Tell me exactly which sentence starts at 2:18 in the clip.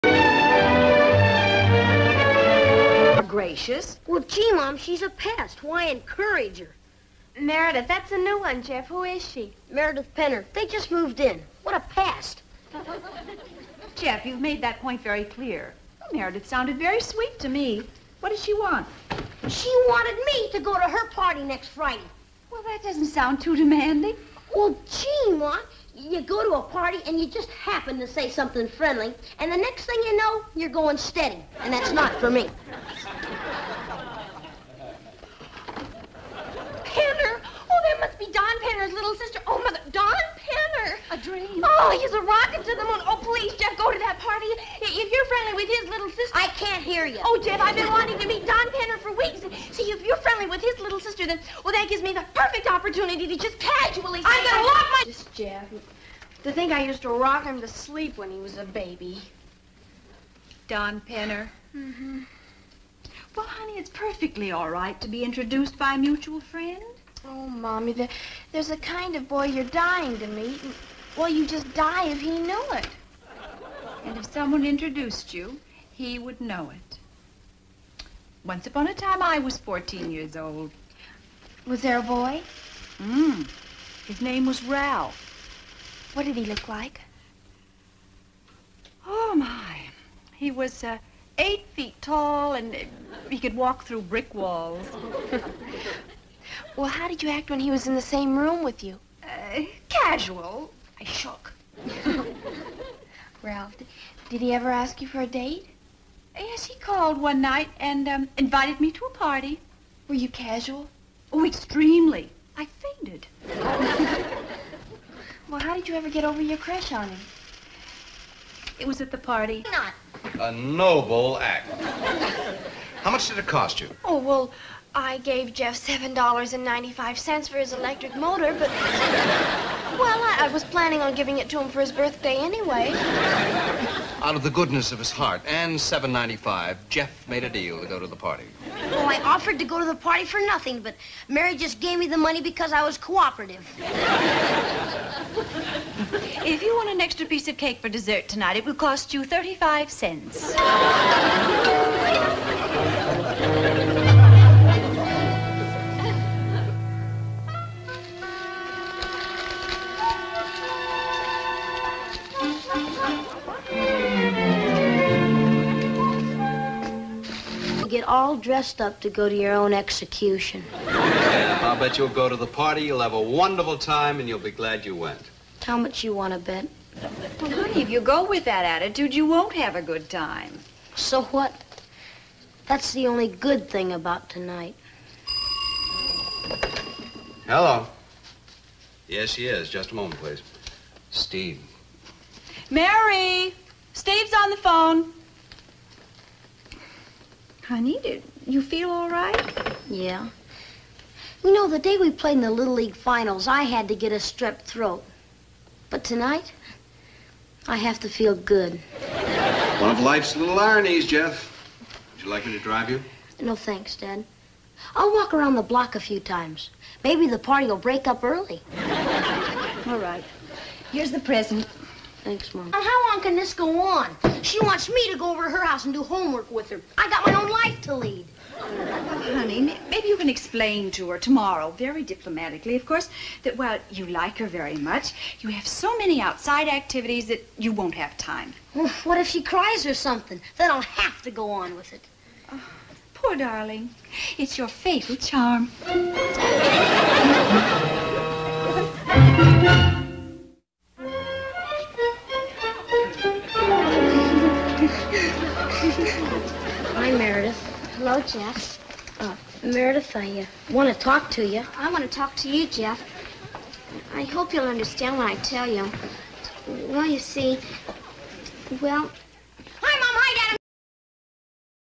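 Oh, I offered to go to the party for nothing, but Mary just gave me the money because I was cooperative.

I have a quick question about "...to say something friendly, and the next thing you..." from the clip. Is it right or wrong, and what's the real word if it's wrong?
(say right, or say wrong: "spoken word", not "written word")
right.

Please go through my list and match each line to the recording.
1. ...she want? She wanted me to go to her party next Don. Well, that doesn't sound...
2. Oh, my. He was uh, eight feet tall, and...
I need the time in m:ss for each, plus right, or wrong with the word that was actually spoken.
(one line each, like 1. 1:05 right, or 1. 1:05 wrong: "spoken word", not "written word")
1. 0:18 wrong: "Friday", not "Don"
2. 1:29 right.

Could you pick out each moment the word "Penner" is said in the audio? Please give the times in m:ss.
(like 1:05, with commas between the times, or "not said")
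0:10, 0:40, 0:48, 1:01.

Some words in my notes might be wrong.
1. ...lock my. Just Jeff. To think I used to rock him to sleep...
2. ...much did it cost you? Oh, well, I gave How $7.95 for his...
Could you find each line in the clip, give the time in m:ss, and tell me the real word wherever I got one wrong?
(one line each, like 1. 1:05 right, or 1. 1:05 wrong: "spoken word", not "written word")
1. 0:54 right
2. 2:03 wrong: "Jeff", not "How".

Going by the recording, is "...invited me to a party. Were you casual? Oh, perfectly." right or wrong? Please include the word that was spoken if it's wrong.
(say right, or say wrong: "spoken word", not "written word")
wrong: "extremely", not "perfectly".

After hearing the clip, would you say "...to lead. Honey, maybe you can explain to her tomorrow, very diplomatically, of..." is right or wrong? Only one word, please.
right.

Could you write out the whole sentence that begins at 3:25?
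But tonight, I have to feel good.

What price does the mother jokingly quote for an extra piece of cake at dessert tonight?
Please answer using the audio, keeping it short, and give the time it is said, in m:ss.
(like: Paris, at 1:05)
35 cents, at 2:29.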